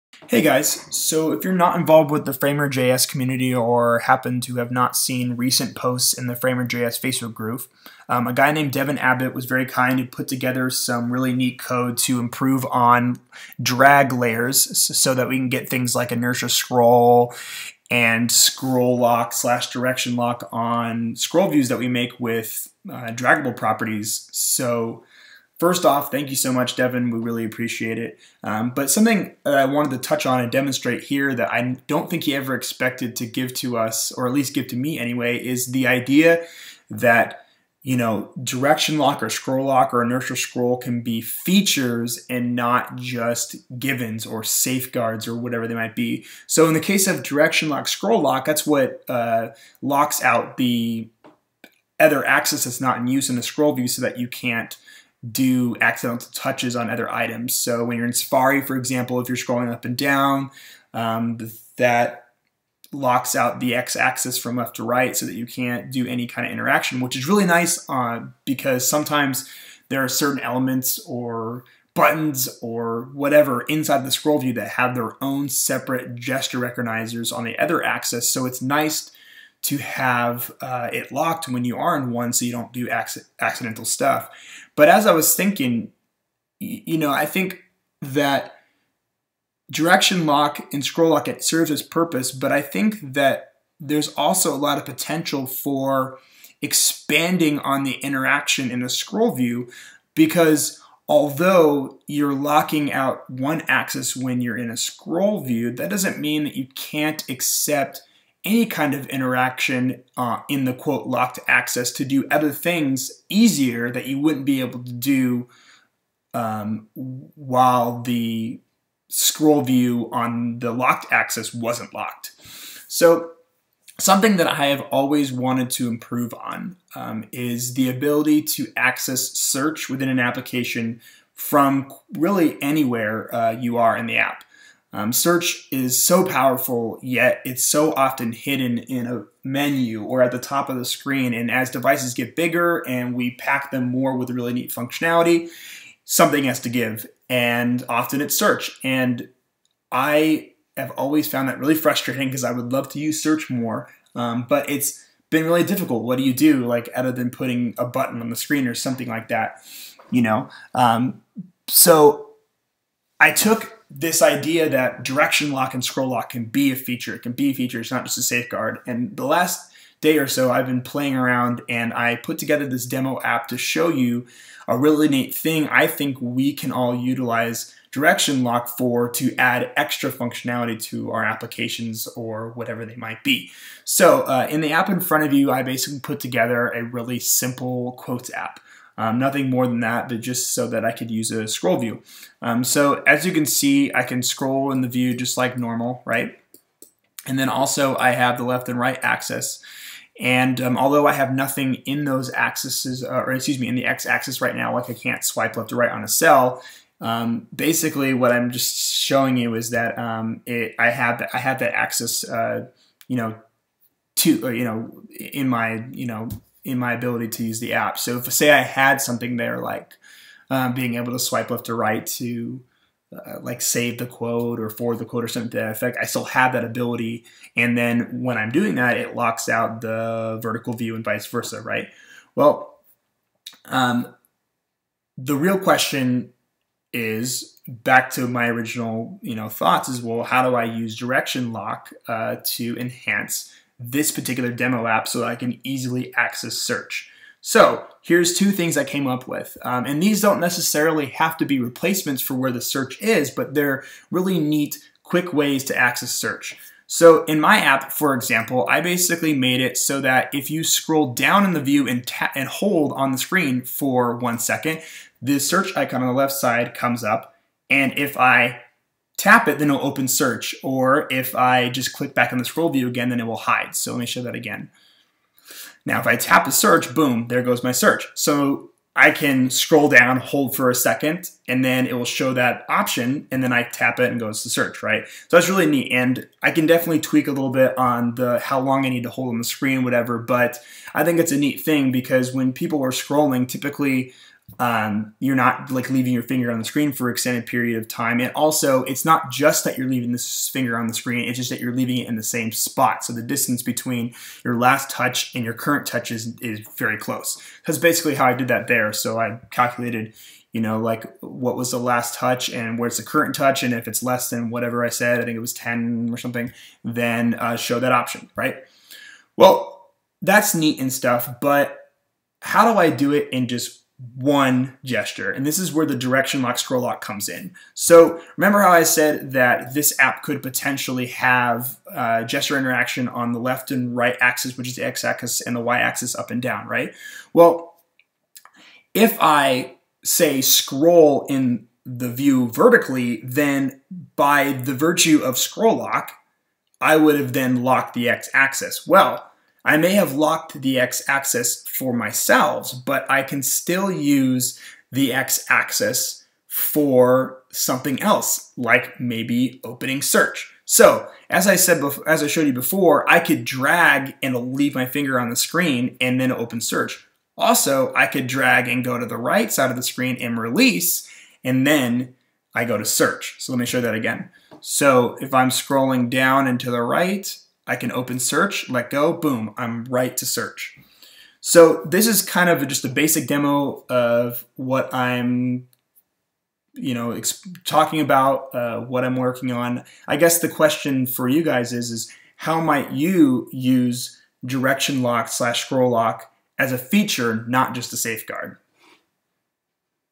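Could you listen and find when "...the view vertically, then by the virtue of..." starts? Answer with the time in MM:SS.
05:41.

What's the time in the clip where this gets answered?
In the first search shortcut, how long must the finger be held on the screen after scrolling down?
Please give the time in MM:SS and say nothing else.
04:24.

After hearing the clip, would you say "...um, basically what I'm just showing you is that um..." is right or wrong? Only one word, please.
right.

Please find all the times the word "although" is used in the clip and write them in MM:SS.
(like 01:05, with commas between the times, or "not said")
01:41, 03:20.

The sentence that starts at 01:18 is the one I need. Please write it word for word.
So it's nice to have uh, it locked when you are in one so you don't do accidental stuff.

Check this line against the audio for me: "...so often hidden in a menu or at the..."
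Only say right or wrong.
right.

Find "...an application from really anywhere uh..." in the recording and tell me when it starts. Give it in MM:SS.
02:10.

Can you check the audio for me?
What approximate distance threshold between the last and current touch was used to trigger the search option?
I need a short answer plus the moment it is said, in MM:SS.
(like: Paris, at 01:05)
10, at 05:15.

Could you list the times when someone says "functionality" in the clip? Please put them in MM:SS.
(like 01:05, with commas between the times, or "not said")
02:24, 03:00.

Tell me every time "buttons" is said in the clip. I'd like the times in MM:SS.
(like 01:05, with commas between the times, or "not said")
01:11, 02:37.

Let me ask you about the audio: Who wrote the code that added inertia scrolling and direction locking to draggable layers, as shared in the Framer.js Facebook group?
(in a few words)
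Devin Abbott.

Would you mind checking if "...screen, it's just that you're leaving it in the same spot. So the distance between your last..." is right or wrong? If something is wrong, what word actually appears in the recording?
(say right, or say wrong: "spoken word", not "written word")
right.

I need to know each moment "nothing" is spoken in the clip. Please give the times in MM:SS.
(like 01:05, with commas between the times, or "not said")
03:09, 03:21.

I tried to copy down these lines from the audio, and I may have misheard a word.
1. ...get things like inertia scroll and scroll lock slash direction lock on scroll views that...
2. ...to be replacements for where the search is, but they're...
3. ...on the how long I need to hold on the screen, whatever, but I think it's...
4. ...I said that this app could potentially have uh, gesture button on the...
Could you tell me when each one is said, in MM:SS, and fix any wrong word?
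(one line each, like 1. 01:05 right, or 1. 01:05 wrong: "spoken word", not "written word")
1. 00:15 right
2. 04:11 right
3. 04:47 right
4. 05:28 wrong: "interaction", not "button".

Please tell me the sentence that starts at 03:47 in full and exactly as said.
And then when I'm doing that, it locks out the vertical view and vice versa, right?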